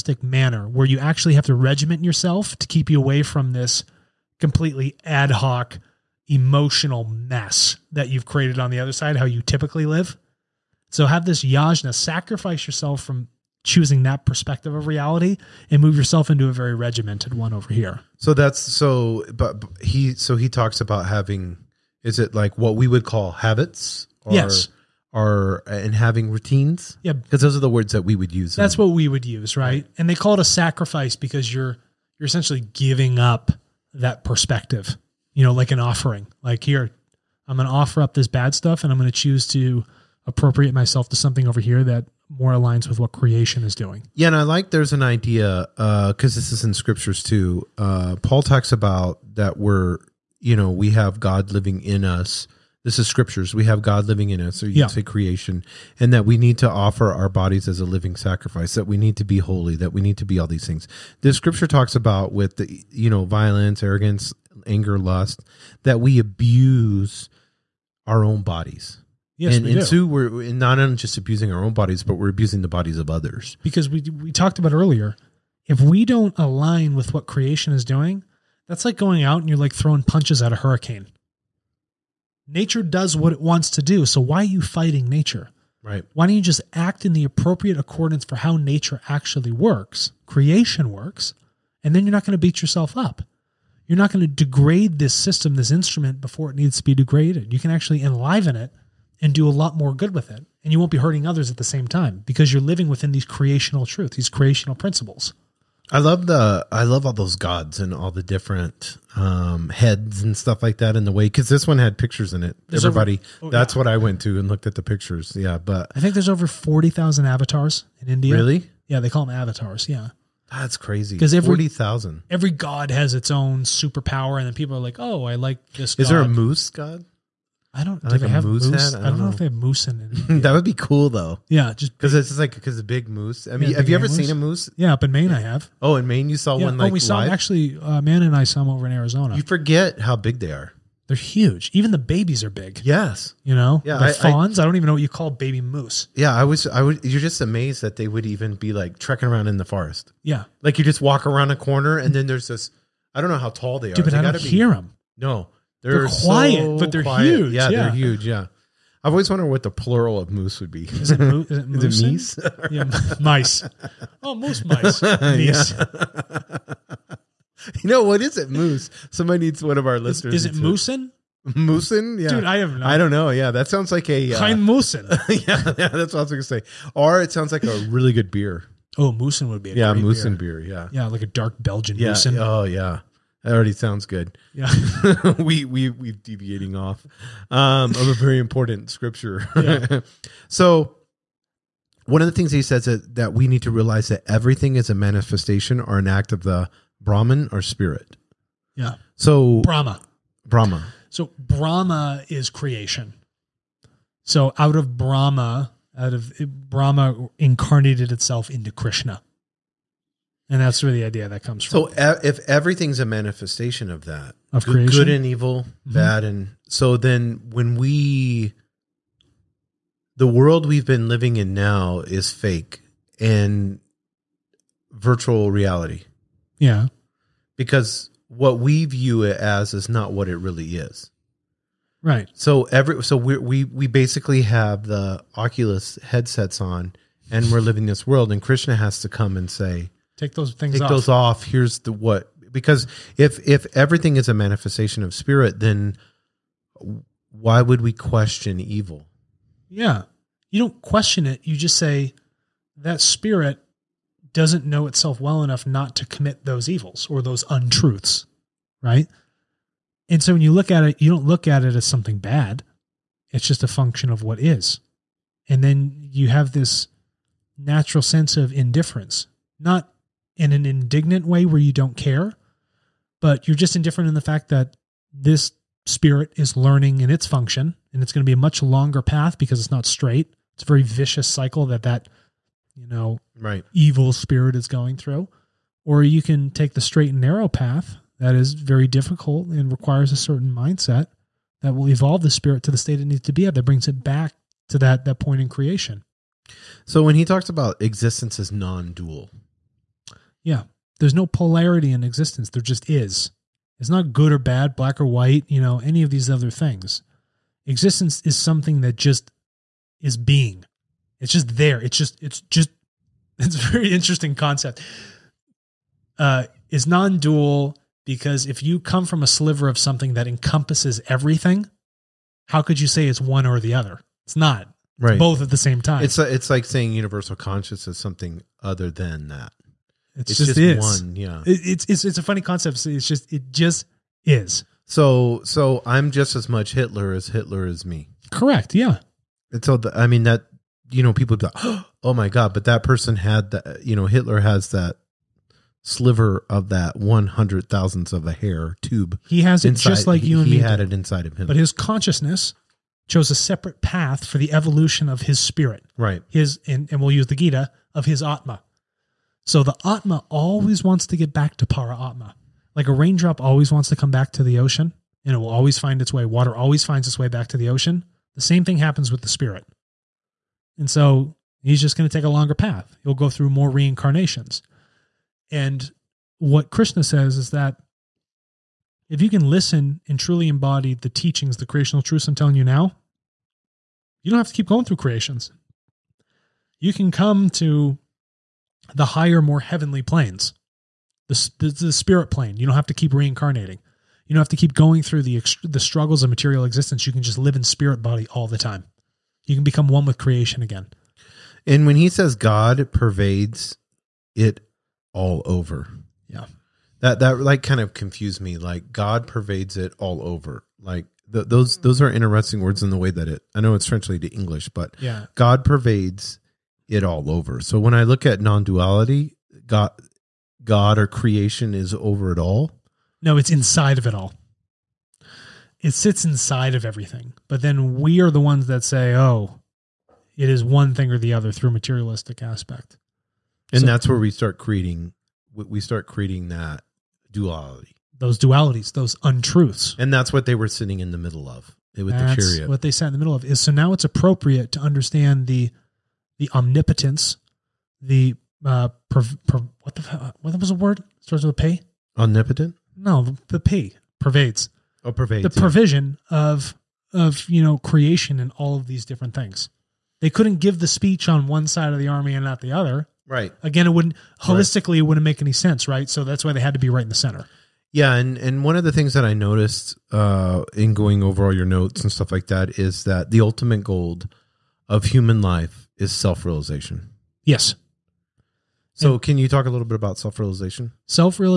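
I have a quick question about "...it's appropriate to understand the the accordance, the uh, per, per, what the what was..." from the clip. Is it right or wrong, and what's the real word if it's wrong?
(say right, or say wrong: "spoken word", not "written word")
wrong: "omnipotence", not "accordance".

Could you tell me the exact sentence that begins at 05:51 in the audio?
But his consciousness chose a separate path for the evolution of his spirit.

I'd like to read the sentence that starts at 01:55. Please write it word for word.
Yeah, but I think there's over forty thousand avatars in India.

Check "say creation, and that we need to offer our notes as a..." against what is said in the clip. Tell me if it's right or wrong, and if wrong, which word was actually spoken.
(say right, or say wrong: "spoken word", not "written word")
wrong: "bodies", not "notes".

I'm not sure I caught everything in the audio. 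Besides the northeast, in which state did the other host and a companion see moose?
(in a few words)
Arizona.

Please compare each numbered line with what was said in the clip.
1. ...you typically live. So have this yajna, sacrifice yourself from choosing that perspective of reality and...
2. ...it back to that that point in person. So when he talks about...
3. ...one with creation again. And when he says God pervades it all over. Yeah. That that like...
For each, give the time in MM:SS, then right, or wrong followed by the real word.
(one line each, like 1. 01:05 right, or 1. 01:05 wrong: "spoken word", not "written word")
1. 00:09 right
2. 04:53 wrong: "creation", not "person"
3. 06:39 right.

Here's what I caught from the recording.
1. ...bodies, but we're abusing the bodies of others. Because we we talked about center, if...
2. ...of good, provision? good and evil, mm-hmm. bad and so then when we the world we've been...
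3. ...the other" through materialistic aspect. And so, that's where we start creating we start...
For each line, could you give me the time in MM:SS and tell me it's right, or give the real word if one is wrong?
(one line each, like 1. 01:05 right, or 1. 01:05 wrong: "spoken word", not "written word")
1. 01:11 wrong: "earlier", not "center"
2. 03:34 wrong: "creation", not "provision"
3. 07:11 right.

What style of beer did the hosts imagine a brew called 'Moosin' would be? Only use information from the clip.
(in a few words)
dark Belgian.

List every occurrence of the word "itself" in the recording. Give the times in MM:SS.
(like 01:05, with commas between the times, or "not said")
03:28, 04:14.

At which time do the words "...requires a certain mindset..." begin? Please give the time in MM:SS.
04:49.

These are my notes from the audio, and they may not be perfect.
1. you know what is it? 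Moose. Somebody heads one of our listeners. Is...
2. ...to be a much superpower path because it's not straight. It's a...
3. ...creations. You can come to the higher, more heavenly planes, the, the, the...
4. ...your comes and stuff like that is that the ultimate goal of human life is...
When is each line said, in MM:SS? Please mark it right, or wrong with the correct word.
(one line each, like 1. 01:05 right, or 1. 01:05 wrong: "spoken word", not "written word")
1. 02:47 wrong: "needs", not "heads"
2. 04:38 wrong: "longer", not "superpower"
3. 06:24 right
4. 07:51 wrong: "notes", not "comes".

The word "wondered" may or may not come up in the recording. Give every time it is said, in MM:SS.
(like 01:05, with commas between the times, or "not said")
02:39.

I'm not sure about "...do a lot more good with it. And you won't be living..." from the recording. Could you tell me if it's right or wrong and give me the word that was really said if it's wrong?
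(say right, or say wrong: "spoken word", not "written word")
wrong: "hurting", not "living".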